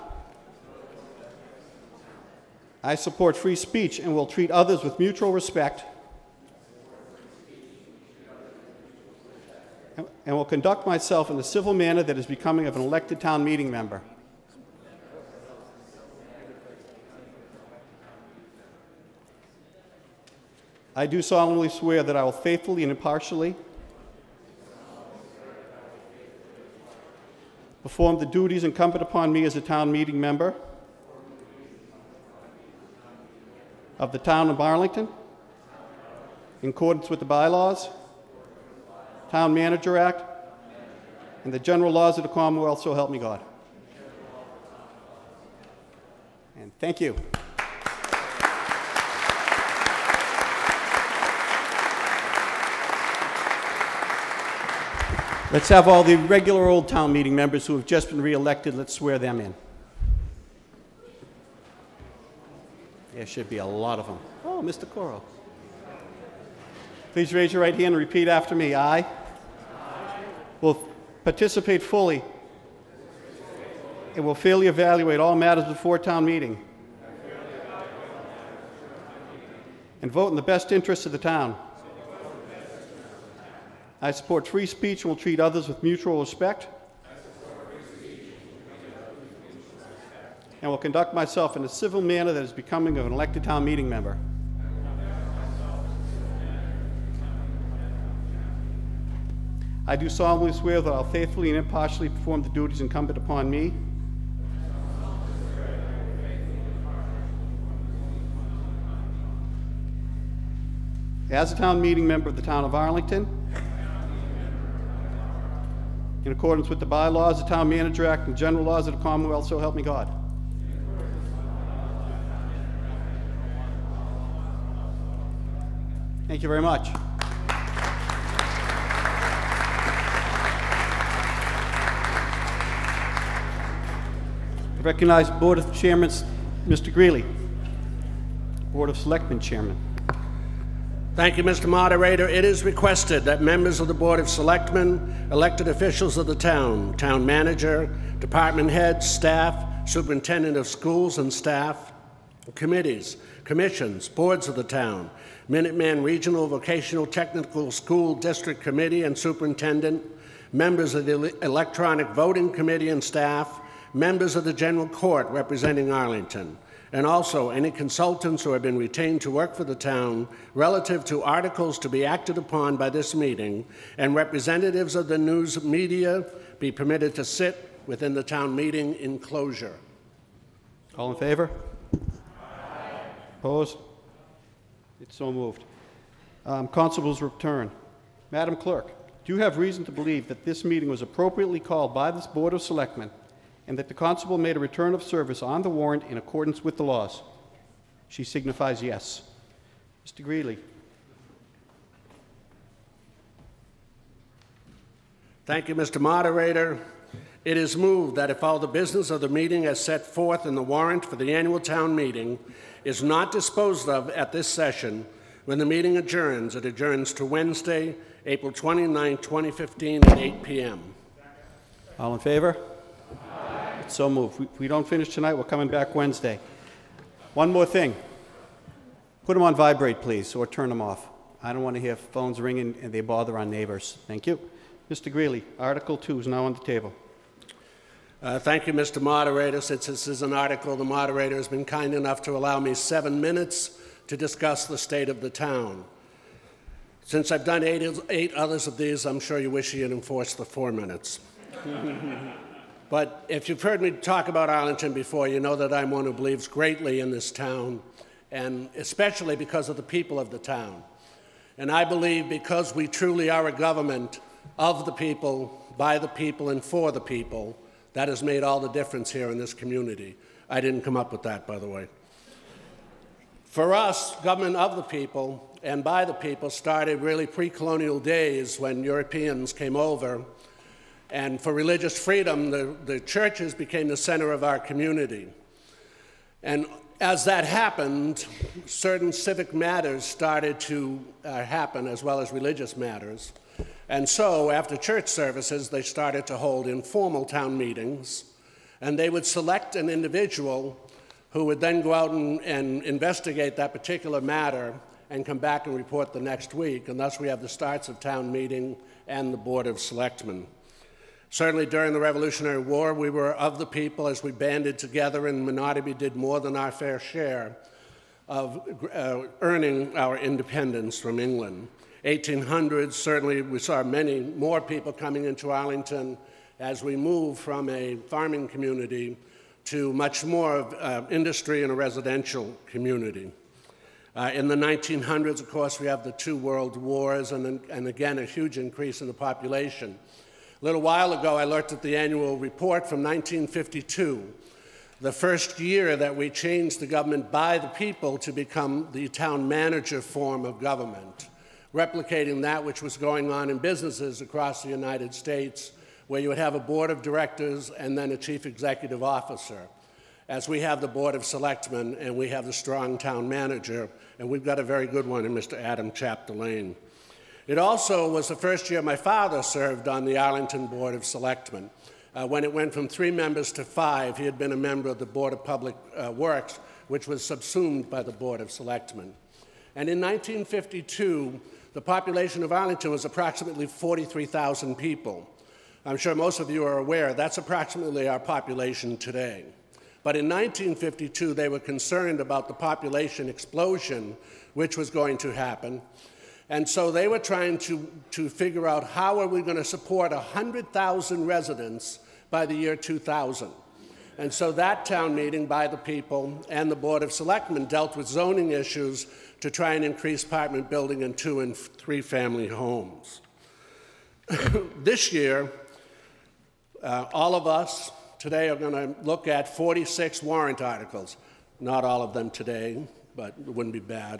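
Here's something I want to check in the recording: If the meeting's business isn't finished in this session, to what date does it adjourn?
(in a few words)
April 29, 2015.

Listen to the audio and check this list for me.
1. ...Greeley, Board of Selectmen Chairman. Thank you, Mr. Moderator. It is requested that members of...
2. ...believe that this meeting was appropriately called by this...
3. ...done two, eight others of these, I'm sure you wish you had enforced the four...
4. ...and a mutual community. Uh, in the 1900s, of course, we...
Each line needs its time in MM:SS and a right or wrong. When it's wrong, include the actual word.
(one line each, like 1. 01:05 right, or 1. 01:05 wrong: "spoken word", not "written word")
1. 02:16 right
2. 03:09 right
3. 04:07 wrong: "eight", not "two"
4. 05:31 wrong: "residential", not "mutual".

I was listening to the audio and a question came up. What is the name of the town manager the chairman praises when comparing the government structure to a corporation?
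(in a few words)
Adam Chapdelaine.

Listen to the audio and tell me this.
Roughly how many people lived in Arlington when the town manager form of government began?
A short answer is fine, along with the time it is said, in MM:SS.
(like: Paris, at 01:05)
43,000, at 06:23.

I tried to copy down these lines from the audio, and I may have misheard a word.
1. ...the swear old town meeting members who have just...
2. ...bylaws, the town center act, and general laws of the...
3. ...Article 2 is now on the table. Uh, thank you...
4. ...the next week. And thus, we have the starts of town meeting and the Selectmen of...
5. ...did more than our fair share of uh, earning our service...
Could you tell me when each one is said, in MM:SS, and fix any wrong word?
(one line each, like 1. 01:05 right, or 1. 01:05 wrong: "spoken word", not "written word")
1. 00:56 wrong: "regular", not "swear"
2. 01:56 wrong: "manager", not "center"
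3. 03:55 right
4. 05:06 wrong: "Board", not "Selectmen"
5. 05:15 wrong: "independence", not "service".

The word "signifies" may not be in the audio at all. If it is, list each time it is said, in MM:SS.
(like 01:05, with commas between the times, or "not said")
03:18.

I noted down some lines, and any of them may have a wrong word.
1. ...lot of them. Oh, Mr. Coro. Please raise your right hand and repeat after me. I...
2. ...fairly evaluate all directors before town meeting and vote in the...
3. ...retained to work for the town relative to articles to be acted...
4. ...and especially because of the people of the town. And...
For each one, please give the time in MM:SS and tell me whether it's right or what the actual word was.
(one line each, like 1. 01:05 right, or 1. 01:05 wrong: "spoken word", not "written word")
1. 01:03 right
2. 01:14 wrong: "matters", not "directors"
3. 02:48 right
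4. 04:18 right.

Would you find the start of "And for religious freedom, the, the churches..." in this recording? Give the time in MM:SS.
04:41.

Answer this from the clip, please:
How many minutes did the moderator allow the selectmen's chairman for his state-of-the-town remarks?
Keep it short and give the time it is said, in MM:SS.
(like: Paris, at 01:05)
7, at 04:02.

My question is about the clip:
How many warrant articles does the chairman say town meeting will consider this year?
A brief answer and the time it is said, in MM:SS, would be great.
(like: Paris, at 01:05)
46, at 06:59.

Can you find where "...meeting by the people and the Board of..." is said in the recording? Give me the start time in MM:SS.
06:45.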